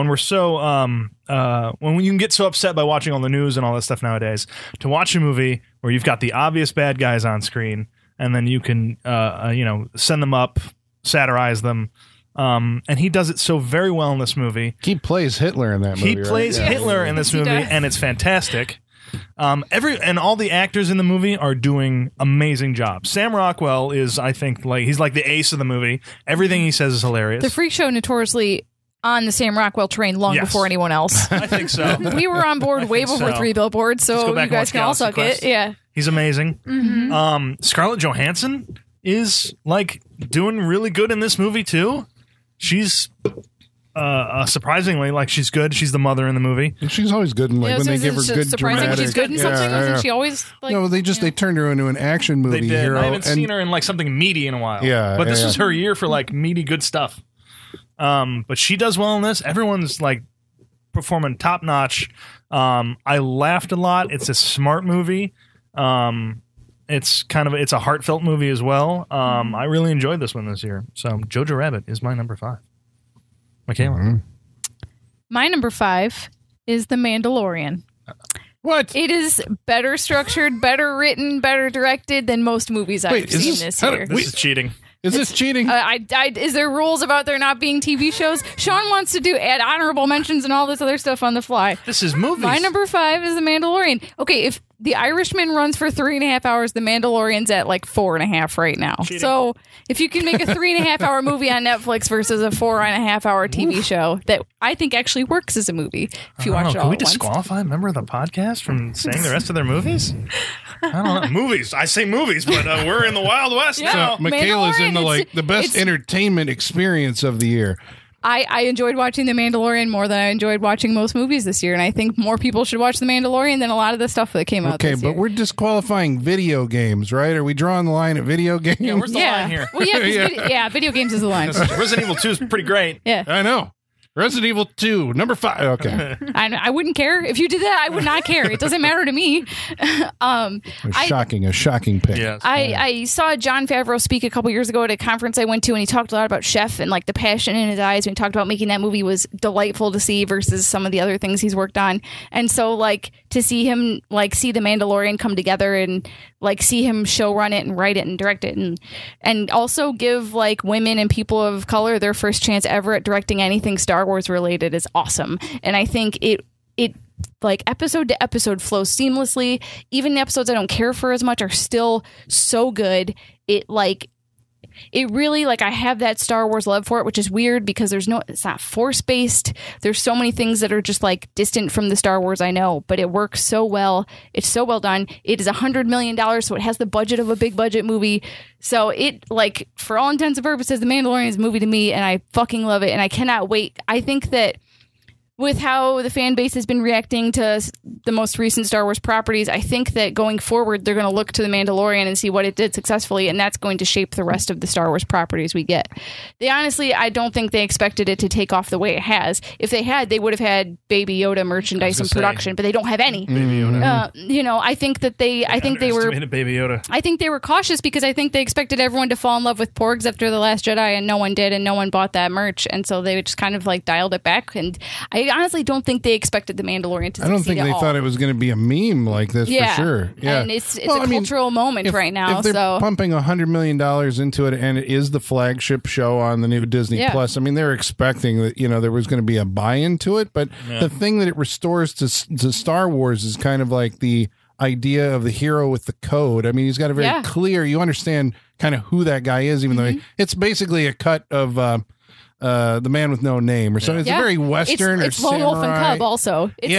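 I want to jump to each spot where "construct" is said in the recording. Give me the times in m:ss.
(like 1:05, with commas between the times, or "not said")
not said.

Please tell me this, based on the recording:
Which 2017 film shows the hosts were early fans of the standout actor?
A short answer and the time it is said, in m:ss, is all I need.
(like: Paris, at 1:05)
Three Billboards, at 0:33.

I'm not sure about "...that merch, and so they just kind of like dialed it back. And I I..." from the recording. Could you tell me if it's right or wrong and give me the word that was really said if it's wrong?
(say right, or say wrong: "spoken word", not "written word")
right.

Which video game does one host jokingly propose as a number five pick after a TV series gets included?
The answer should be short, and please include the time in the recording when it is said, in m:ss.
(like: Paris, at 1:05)
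Resident Evil 2, at 2:14.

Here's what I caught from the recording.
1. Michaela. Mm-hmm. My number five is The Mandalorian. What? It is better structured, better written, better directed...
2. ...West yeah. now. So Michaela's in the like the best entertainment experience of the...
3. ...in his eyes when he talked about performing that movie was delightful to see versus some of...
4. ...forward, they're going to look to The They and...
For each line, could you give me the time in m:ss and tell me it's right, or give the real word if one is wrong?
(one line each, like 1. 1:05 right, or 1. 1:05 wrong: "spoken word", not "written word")
1. 1:13 right
2. 1:53 right
3. 2:27 wrong: "making", not "performing"
4. 3:20 wrong: "Mandalorian", not "They".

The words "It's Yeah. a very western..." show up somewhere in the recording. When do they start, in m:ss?
4:14.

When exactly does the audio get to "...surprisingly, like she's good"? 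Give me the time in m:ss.
0:44.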